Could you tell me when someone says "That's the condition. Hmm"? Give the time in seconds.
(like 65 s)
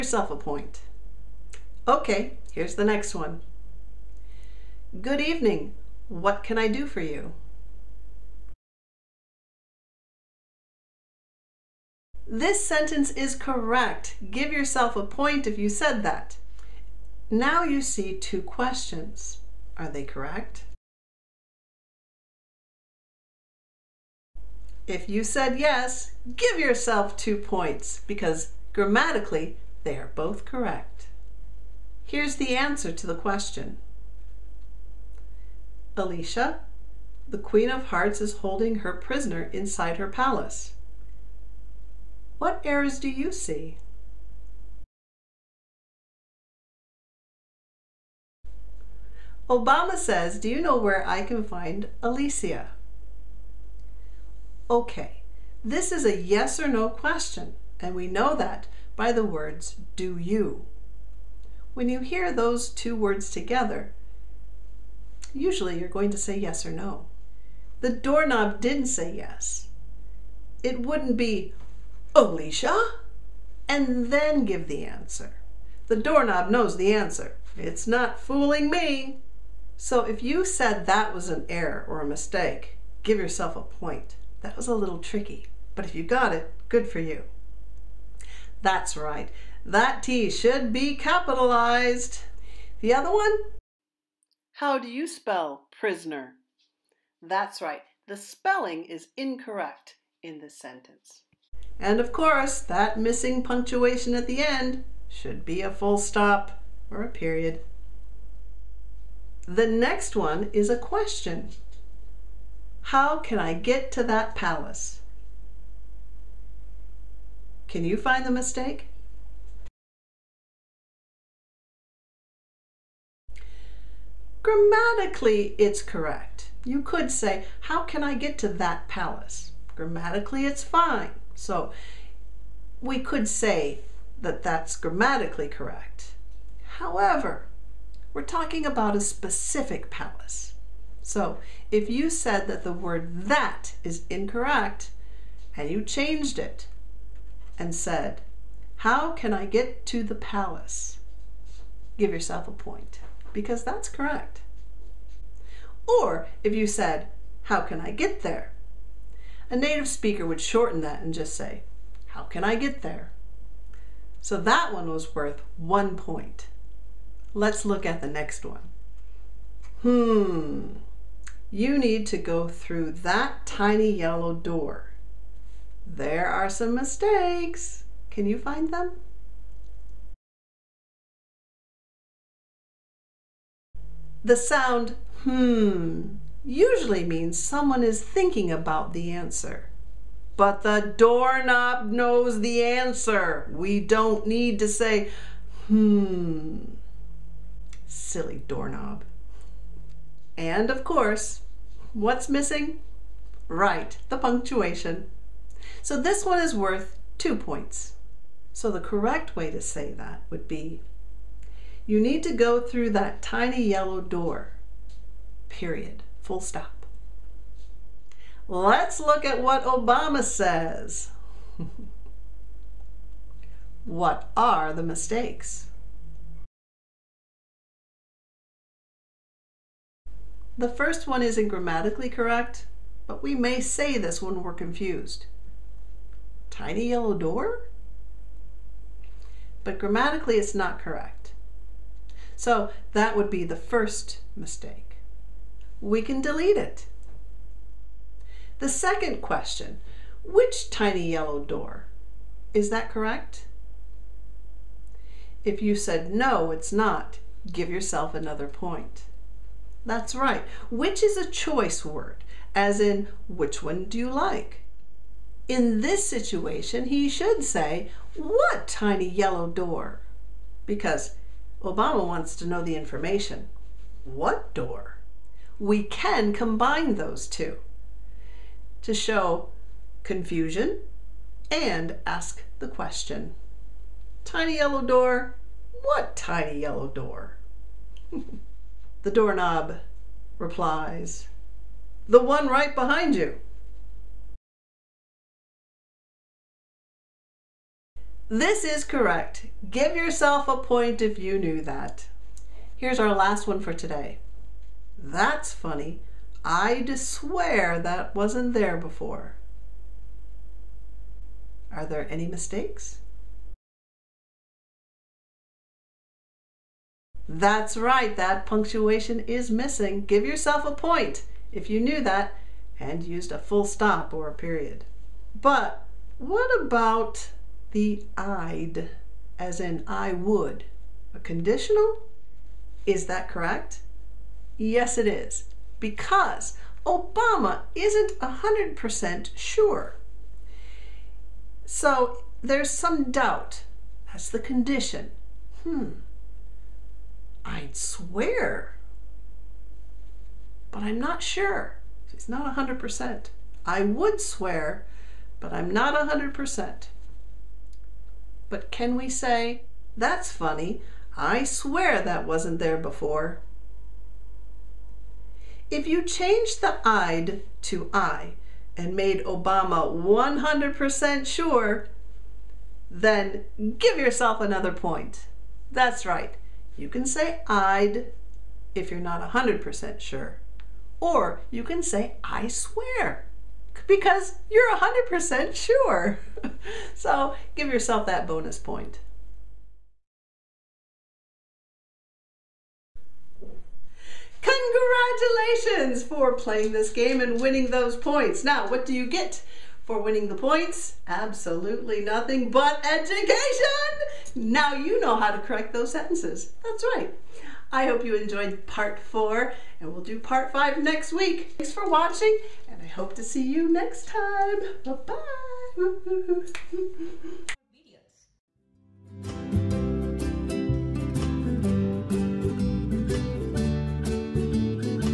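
344 s.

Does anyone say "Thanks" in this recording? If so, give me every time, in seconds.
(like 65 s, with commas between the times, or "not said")
411 s.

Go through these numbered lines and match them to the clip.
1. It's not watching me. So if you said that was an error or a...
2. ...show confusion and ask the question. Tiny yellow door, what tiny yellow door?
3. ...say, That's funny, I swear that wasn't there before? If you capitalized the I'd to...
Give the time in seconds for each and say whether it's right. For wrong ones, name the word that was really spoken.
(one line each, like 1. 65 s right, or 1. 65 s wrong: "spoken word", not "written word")
1. 77 s wrong: "fooling", not "watching"
2. 278 s right
3. 359 s wrong: "changed", not "capitalized".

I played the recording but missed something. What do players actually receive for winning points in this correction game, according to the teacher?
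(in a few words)
Absolutely nothing but education.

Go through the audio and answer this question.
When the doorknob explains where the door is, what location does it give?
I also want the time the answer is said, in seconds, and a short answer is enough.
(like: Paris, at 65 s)
right behind you, at 292 s.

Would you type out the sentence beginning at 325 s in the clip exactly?
But what about the I'd, as in I would.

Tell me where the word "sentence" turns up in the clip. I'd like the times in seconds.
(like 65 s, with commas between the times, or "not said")
12 s, 100 s, 405 s.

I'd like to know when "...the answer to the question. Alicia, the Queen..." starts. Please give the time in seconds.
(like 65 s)
32 s.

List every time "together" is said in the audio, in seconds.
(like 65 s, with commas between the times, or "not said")
63 s.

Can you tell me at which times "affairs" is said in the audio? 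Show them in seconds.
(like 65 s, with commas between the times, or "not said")
not said.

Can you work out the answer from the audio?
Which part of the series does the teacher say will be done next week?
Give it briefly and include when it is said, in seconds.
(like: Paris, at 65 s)
part 5, at 410 s.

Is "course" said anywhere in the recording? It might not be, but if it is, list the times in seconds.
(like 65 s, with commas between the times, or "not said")
102 s, 200 s.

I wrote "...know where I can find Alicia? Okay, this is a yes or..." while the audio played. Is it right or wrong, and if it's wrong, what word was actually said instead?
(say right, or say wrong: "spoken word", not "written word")
right.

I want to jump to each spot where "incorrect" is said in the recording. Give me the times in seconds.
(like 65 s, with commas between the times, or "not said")
99 s, 144 s.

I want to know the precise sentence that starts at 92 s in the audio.
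The other one, how do you spell prisoner?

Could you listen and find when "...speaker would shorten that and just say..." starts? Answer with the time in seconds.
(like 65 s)
159 s.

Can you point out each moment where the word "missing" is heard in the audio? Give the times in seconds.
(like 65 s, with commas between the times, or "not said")
103 s, 202 s, 319 s.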